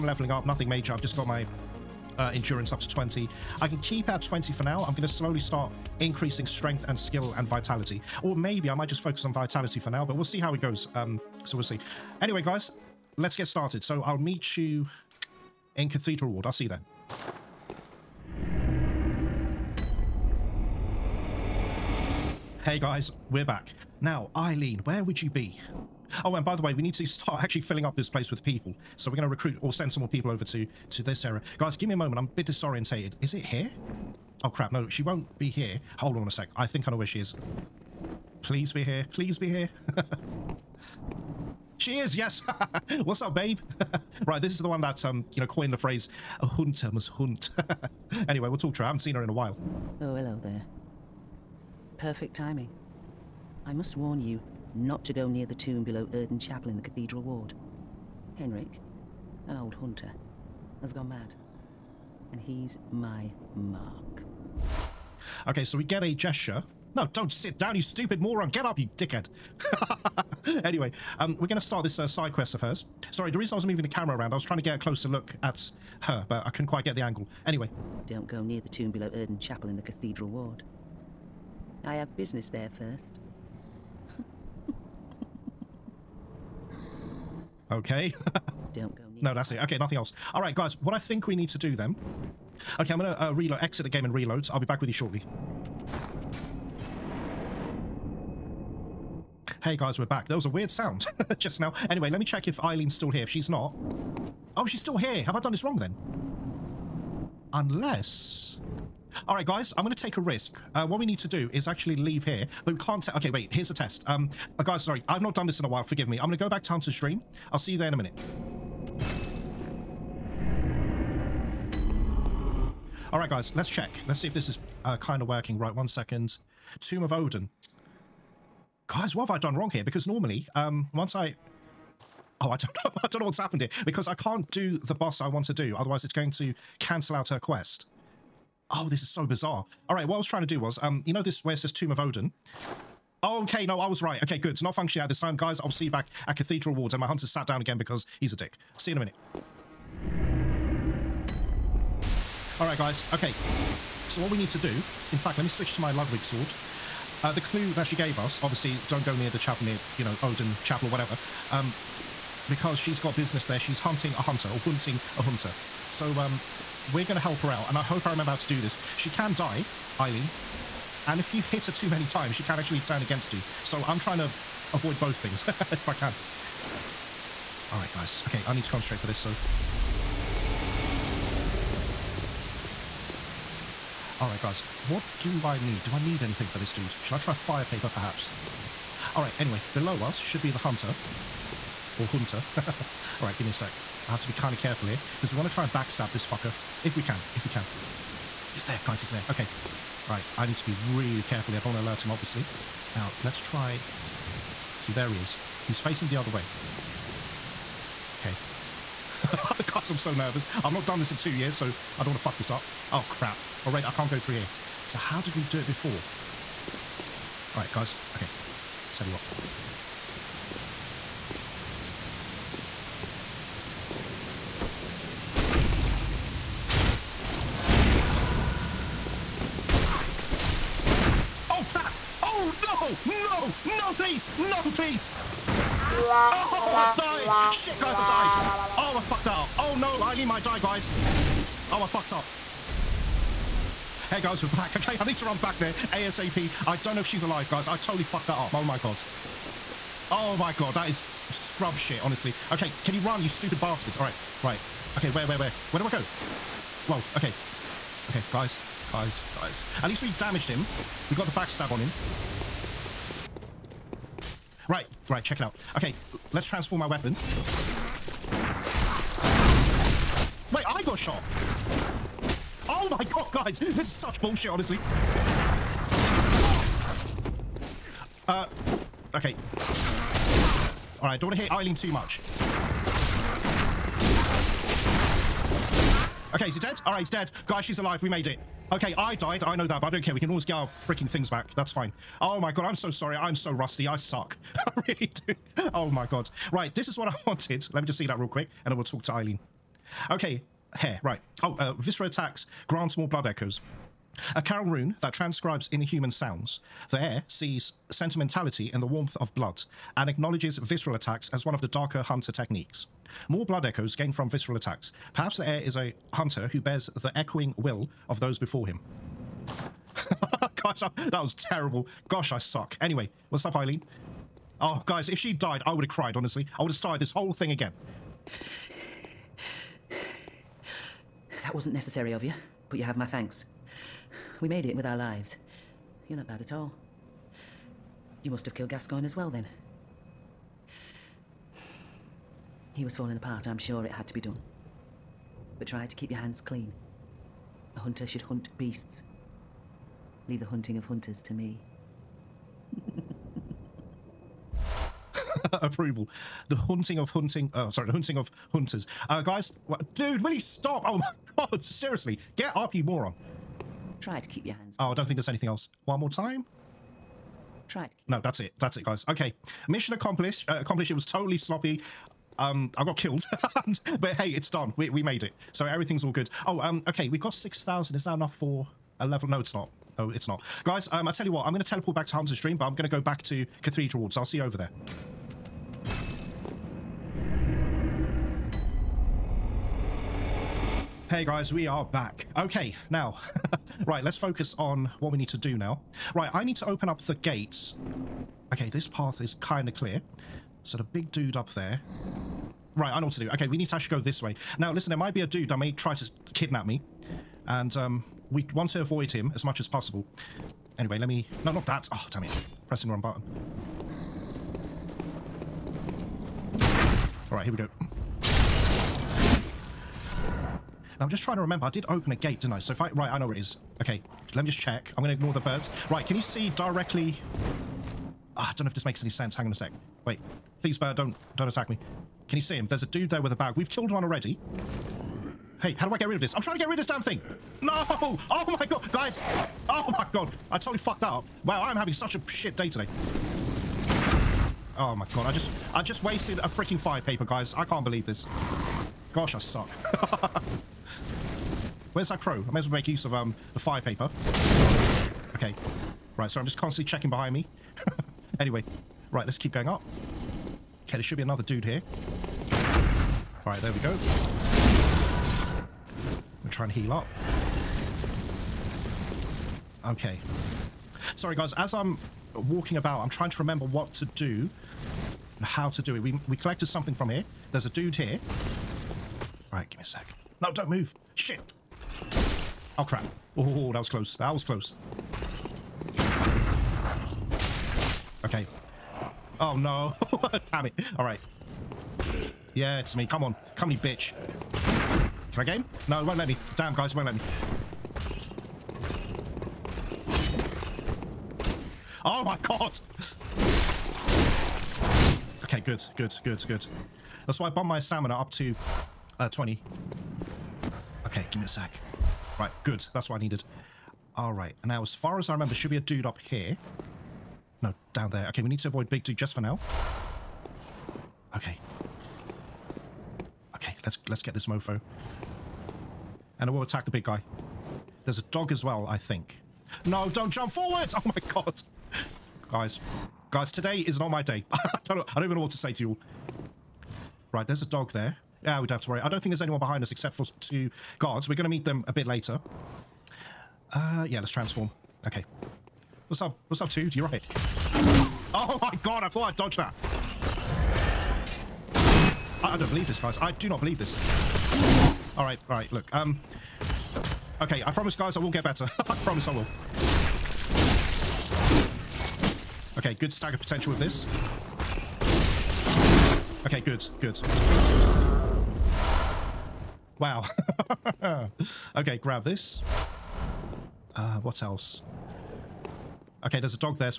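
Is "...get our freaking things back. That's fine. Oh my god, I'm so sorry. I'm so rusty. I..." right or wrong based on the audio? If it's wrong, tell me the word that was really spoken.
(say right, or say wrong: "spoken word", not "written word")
right.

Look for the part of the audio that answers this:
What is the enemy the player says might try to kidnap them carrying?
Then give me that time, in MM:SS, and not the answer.
07:13.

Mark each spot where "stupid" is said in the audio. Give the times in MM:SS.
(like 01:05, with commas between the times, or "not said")
01:07, 04:13.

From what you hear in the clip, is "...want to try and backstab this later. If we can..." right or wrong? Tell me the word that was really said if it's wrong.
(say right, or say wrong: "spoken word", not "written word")
wrong: "fucker", not "later".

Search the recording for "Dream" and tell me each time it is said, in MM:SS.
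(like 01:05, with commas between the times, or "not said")
01:56, 06:22.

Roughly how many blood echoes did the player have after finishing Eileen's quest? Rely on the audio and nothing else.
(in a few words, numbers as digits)
6000.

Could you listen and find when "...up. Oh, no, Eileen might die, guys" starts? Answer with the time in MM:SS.
03:59.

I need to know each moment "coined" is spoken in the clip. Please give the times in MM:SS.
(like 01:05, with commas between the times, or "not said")
00:45.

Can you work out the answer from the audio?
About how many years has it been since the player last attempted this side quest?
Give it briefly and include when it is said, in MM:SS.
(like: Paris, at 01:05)
2, at 03:31.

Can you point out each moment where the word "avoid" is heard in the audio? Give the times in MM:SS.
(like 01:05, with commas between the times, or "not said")
02:54, 06:48, 08:38.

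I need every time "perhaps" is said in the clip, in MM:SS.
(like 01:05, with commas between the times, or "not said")
03:07, 05:15.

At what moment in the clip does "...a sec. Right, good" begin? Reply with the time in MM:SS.
08:31.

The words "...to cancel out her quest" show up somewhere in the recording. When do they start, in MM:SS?
02:16.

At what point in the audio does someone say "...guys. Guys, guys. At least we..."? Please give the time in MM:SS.
04:18.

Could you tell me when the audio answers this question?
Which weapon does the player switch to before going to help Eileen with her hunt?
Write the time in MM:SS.
02:35.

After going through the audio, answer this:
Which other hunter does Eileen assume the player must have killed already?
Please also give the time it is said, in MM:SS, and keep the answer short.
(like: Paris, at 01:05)
Gascoigne, at 05:38.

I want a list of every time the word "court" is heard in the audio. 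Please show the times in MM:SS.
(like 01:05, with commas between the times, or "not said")
not said.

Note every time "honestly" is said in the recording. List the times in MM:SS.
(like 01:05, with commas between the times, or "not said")
04:11, 04:34, 05:26.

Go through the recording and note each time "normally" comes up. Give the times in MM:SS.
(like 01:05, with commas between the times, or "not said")
02:10.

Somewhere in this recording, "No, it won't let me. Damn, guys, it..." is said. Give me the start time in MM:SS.
08:15.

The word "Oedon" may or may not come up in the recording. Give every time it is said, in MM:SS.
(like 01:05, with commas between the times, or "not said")
00:56, 01:19, 02:07, 02:21, 02:40.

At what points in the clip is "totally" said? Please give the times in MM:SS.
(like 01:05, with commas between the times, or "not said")
04:07, 06:11, 07:20.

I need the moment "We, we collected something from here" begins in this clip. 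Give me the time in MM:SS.
07:55.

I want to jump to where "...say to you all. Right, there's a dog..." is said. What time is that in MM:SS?
08:55.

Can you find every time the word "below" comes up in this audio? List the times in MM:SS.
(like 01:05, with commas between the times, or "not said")
00:55, 01:18, 03:09.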